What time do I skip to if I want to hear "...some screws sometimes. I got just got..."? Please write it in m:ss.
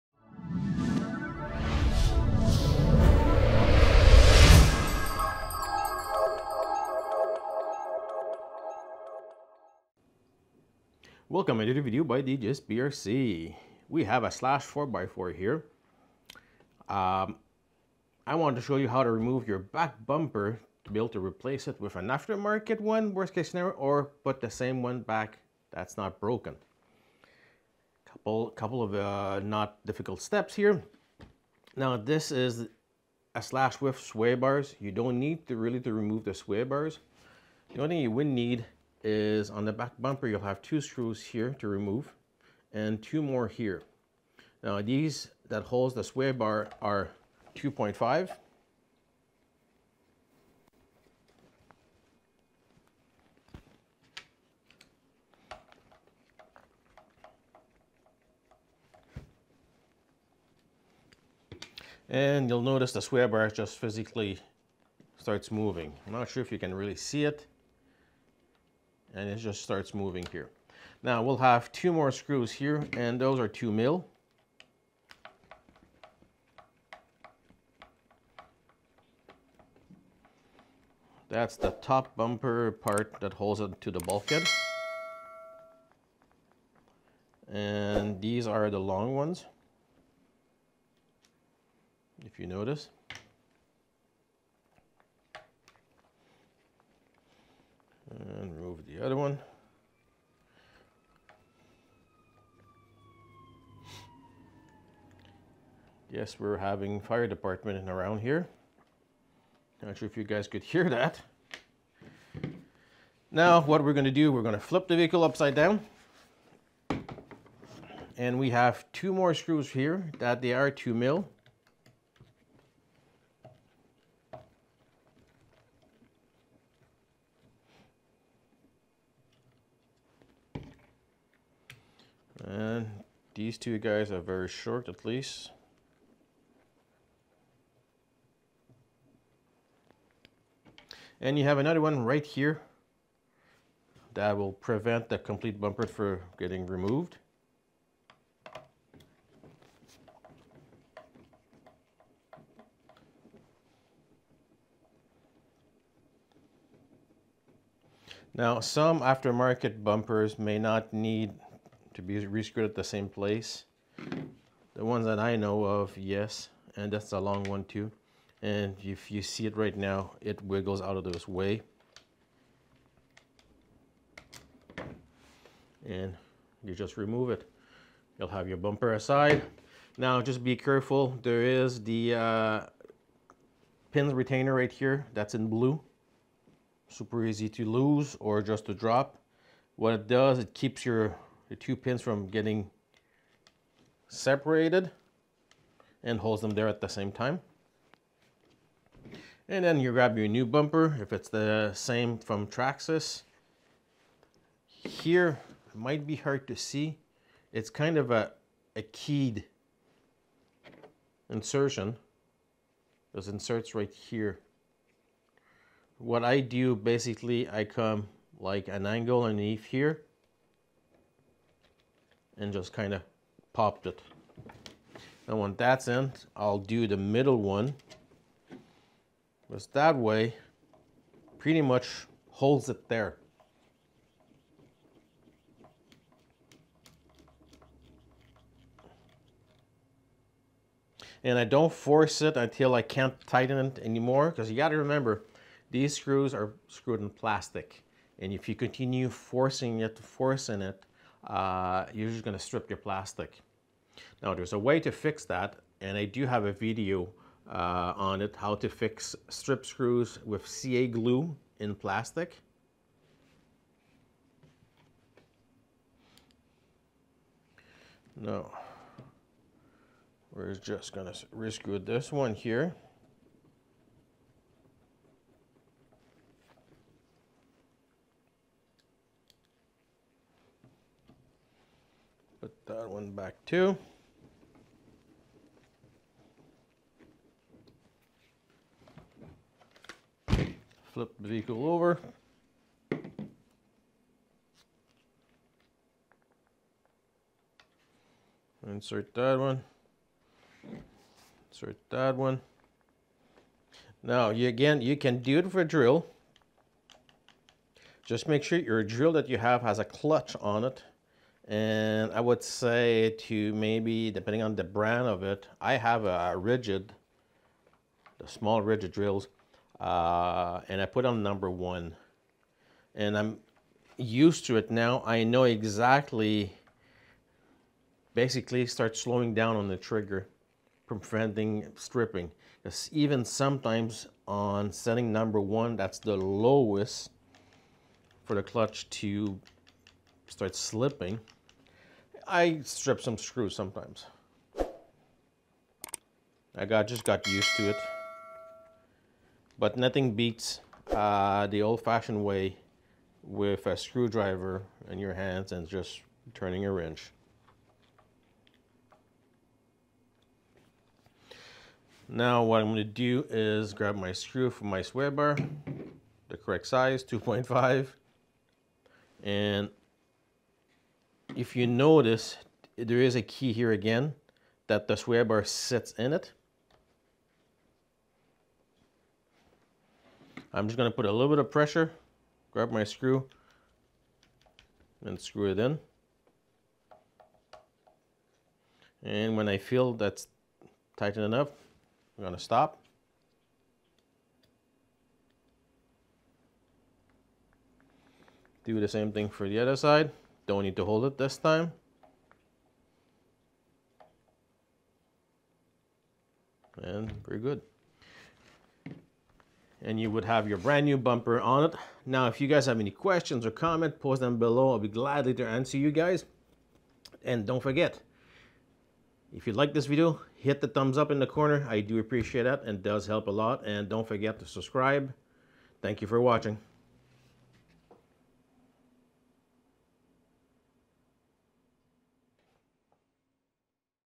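5:43.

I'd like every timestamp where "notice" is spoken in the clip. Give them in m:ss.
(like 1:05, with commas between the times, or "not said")
1:02, 1:32, 6:11.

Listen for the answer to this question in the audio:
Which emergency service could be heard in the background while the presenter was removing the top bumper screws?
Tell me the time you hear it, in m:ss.
1:46.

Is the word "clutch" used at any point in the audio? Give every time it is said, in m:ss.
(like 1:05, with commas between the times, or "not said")
5:09, 5:38.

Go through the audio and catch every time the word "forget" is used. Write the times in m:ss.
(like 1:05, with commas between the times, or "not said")
6:57, 7:04.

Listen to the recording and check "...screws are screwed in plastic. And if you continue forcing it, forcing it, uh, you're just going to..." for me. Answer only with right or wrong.
right.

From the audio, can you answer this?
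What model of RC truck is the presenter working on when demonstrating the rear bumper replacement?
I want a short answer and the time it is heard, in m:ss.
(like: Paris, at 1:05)
Slash 4x4, at 0:14.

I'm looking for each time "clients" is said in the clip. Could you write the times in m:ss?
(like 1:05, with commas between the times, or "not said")
not said.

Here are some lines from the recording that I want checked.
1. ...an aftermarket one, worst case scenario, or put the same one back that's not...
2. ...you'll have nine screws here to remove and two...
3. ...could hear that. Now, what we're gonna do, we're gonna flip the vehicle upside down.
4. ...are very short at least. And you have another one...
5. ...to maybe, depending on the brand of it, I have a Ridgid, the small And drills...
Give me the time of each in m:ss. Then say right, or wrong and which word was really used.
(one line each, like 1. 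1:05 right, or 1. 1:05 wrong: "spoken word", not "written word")
1. 0:21 right
2. 0:40 wrong: "two", not "nine"
3. 1:50 right
4. 2:14 right
5. 5:13 wrong: "Ridgid", not "And".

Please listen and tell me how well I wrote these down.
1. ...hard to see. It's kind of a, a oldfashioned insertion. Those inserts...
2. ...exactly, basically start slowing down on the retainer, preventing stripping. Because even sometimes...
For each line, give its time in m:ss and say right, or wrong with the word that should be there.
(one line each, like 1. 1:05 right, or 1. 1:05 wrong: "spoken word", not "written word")
1. 3:26 wrong: "keyed", not "oldfashioned"
2. 5:25 wrong: "trigger", not "retainer".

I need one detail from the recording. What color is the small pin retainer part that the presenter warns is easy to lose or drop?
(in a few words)
Blue.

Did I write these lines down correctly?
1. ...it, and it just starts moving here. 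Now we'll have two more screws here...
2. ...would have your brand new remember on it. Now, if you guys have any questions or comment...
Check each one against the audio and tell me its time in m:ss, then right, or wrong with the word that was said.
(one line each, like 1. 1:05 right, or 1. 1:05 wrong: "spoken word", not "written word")
1. 1:07 right
2. 6:50 wrong: "bumper", not "remember".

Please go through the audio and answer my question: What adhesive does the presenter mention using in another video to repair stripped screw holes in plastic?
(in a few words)
CA glue.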